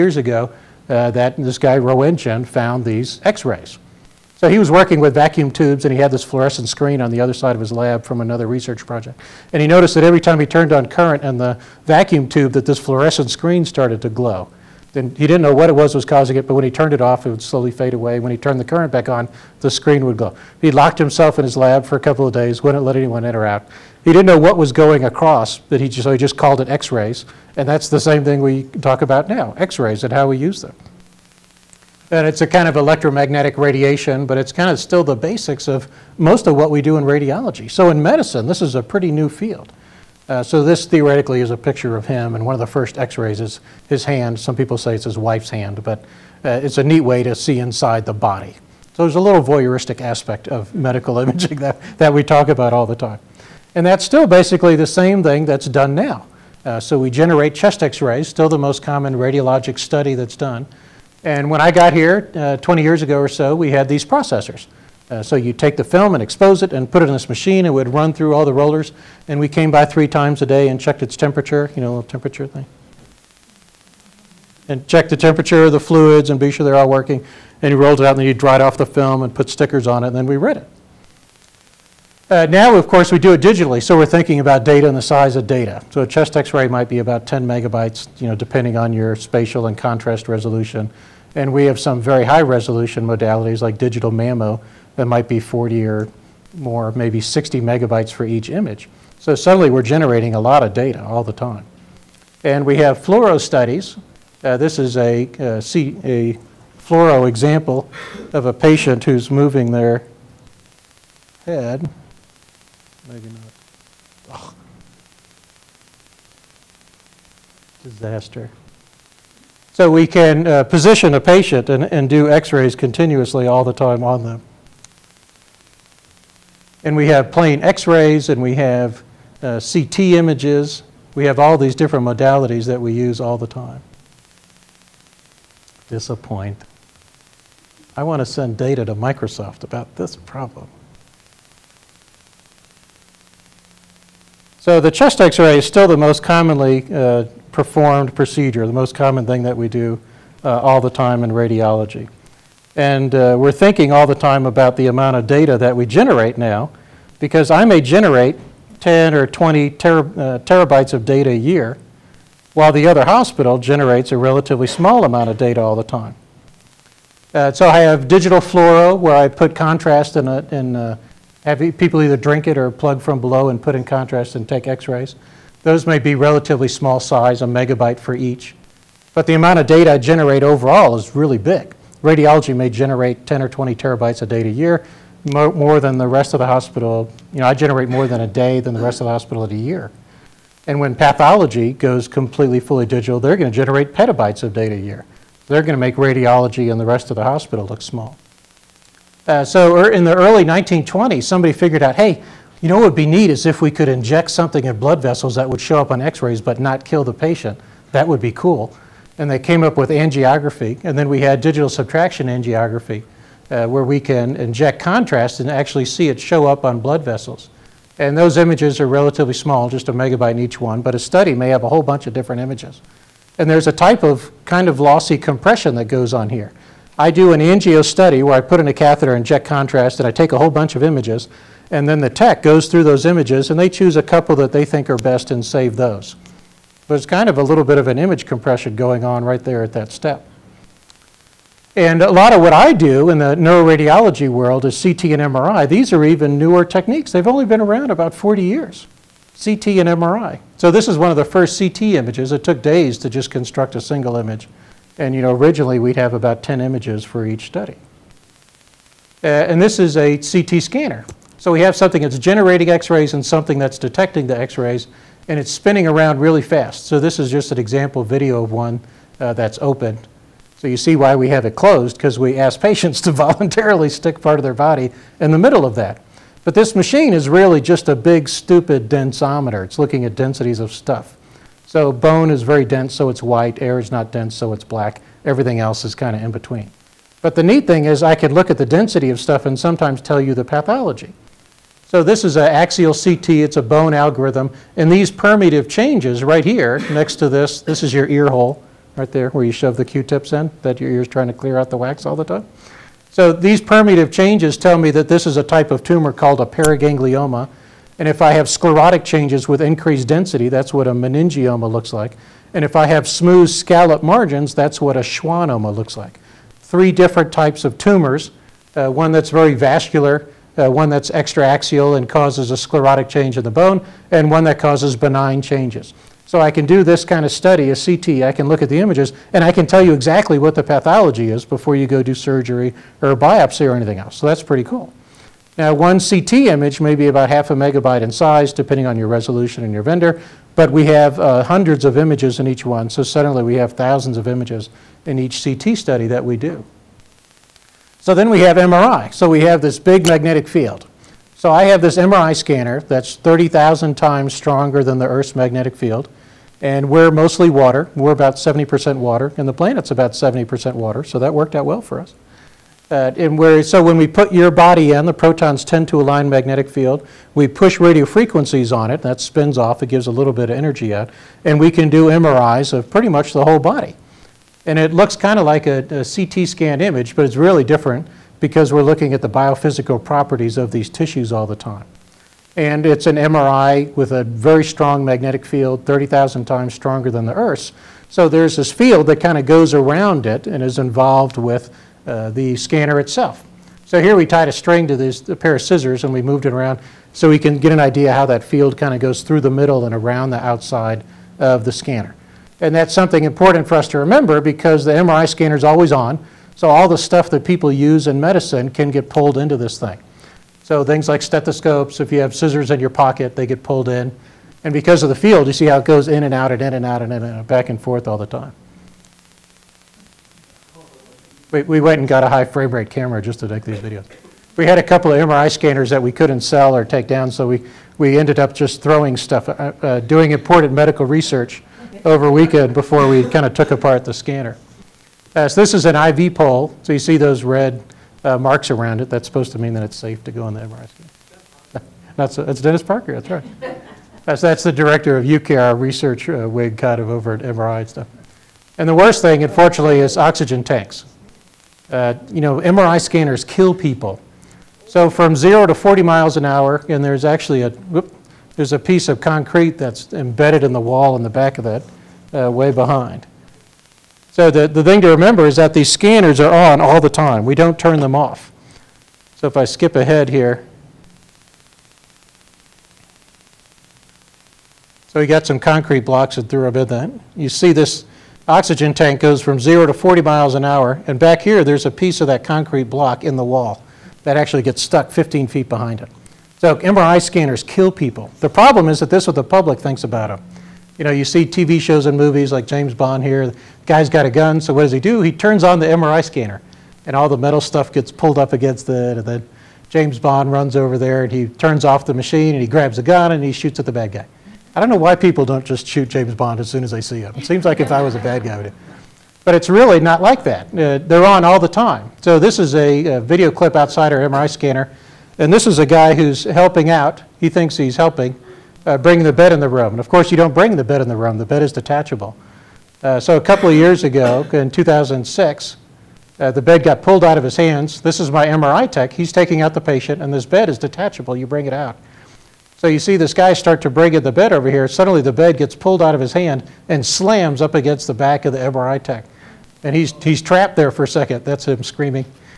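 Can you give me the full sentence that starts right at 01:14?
And check the temperature of the fluids and be sure they're all working.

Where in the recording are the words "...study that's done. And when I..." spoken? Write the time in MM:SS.
00:59.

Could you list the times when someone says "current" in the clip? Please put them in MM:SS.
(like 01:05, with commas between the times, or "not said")
00:10, 00:18.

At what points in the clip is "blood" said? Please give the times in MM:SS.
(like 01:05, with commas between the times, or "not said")
03:24, 03:36.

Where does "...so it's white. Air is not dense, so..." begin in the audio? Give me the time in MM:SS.
04:42.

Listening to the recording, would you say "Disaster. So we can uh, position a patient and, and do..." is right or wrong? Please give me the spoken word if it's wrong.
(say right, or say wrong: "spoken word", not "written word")
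right.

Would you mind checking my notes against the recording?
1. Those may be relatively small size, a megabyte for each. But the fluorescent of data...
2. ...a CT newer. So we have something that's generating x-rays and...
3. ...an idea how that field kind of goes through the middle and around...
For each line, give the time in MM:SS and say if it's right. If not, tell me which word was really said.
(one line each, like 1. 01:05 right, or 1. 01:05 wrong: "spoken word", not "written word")
1. 02:55 wrong: "amount", not "fluorescent"
2. 04:19 wrong: "scanner", not "newer"
3. 06:37 right.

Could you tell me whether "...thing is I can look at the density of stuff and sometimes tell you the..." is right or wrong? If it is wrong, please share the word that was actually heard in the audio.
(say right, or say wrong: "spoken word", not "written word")
right.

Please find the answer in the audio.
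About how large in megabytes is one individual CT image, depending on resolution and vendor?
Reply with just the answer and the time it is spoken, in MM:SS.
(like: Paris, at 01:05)
half a megabyte, at 05:37.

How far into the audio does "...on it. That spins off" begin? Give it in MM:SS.
06:08.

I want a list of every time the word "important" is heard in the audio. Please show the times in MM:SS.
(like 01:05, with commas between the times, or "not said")
06:43, 07:10.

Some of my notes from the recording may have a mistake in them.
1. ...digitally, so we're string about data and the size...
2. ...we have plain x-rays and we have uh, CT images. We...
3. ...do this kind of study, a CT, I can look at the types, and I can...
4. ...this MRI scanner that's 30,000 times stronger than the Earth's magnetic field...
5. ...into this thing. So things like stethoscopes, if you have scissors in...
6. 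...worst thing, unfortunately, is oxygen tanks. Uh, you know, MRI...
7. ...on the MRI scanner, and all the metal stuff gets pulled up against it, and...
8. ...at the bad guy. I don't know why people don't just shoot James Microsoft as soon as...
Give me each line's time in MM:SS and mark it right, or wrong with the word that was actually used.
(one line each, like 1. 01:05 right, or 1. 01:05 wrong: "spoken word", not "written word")
1. 01:23 wrong: "thinking", not "string"
2. 02:06 right
3. 05:26 wrong: "images", not "types"
4. 05:51 right
5. 06:49 right
6. 07:28 right
7. 08:15 right
8. 08:23 wrong: "Bond", not "Microsoft".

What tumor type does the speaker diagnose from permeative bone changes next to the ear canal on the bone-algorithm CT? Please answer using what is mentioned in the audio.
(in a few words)
paraganglioma.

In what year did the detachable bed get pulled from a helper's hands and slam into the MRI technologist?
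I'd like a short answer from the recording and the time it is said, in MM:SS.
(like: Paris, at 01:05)
2006, at 08:44.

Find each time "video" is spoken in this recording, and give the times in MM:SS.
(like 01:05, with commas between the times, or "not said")
04:28, 07:03, 08:33.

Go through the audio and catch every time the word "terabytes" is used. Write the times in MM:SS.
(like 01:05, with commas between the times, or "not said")
02:40, 03:03.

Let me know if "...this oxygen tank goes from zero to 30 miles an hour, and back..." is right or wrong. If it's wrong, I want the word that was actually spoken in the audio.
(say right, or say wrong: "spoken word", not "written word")
wrong: "40", not "30".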